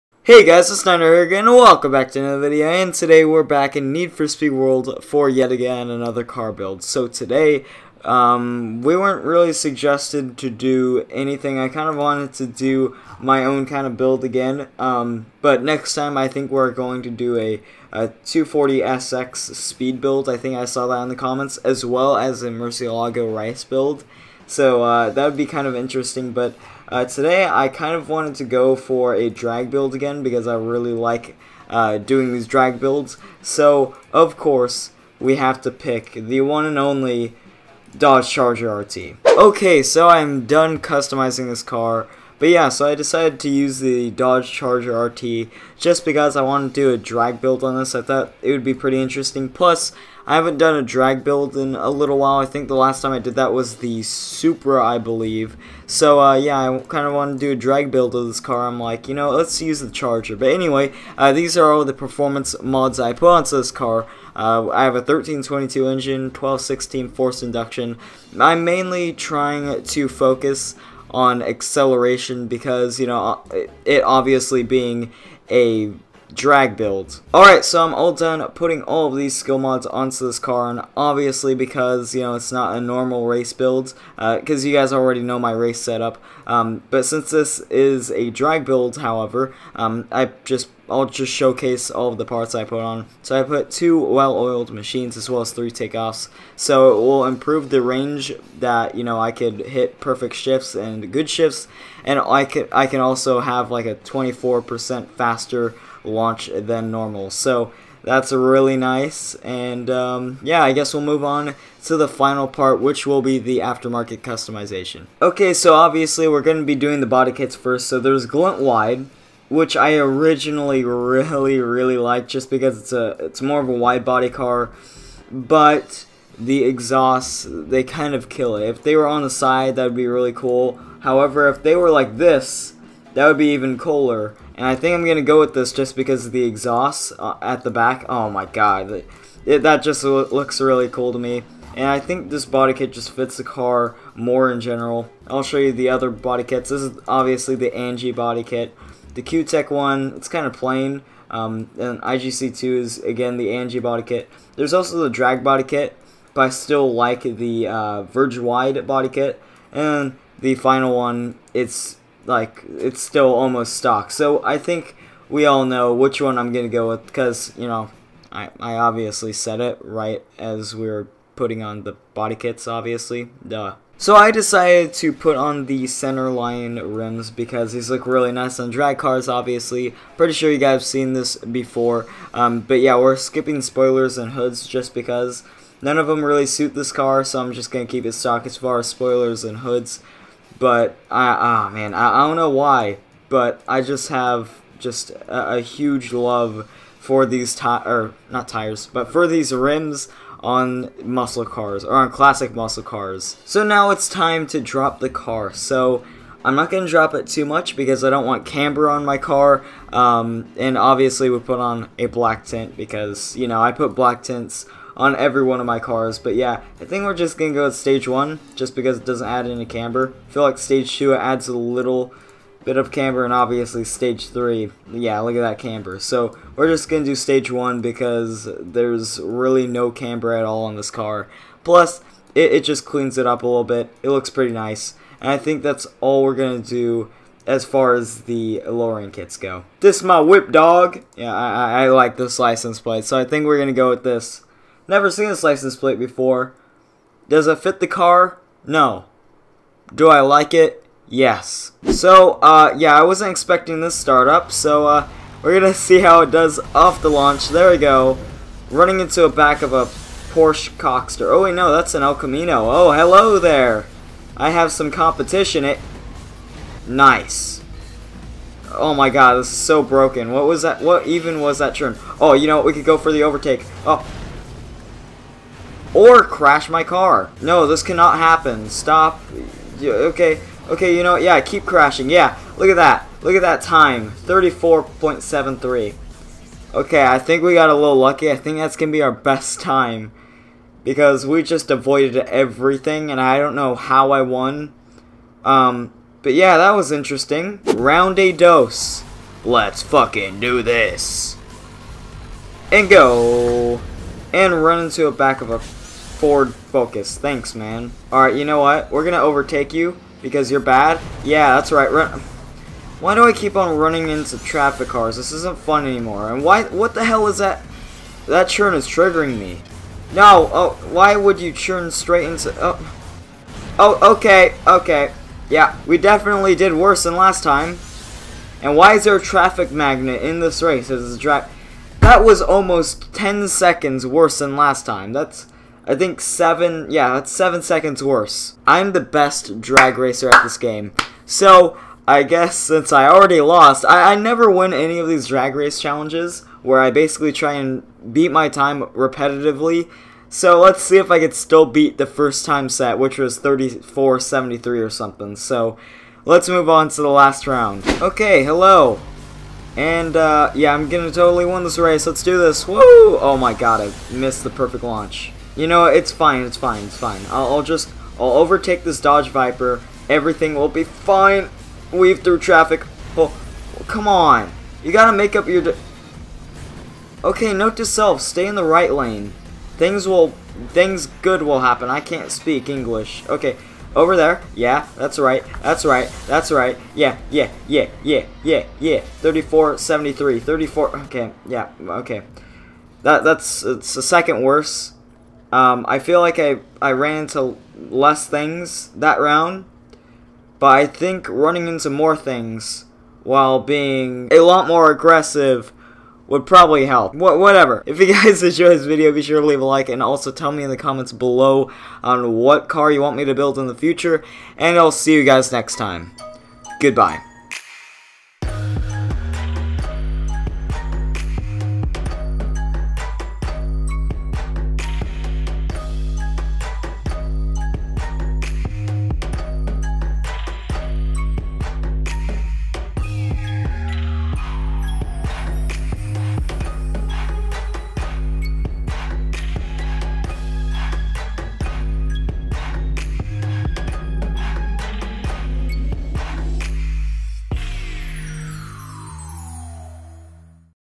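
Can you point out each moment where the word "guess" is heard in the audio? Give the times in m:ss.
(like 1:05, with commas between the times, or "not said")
1:50, 5:42.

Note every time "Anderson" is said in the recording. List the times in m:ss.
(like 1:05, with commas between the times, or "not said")
not said.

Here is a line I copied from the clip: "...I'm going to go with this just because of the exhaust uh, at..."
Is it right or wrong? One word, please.
right.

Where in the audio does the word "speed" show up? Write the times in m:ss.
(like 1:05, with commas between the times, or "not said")
0:04, 0:19.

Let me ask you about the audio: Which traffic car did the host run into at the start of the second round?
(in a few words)
Ford Focus.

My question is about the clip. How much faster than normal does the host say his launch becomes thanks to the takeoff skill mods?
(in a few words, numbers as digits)
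24%.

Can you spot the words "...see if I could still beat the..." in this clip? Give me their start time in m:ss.
5:50.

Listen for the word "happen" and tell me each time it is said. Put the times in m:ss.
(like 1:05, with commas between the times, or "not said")
4:38, 6:21.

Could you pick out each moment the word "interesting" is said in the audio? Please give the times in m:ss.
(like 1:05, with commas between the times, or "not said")
0:25, 0:49, 4:56.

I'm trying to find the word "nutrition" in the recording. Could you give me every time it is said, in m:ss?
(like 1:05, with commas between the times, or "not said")
not said.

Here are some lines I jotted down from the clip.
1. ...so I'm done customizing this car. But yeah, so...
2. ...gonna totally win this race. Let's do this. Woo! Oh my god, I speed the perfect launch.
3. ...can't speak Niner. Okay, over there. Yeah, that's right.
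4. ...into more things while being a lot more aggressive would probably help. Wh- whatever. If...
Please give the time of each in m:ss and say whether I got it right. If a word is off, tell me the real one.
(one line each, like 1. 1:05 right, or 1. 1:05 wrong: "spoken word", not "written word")
1. 0:39 right
2. 6:00 wrong: "missed", not "speed"
3. 6:21 wrong: "English", not "Niner"
4. 6:41 right.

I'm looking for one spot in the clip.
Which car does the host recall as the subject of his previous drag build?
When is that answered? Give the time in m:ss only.
0:54.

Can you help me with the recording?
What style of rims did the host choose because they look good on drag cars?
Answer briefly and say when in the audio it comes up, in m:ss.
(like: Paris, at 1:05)
Center line, at 2:55.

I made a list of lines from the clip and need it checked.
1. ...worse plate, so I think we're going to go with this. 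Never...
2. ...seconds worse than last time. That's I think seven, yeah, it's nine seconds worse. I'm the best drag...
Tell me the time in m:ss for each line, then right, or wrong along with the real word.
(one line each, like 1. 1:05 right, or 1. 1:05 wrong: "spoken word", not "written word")
1. 4:02 wrong: "license", not "worse"
2. 5:33 wrong: "seven", not "nine".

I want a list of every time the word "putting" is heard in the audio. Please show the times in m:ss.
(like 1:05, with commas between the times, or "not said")
1:18, 2:51.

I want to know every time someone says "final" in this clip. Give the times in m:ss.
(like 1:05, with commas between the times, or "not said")
1:52, 2:40.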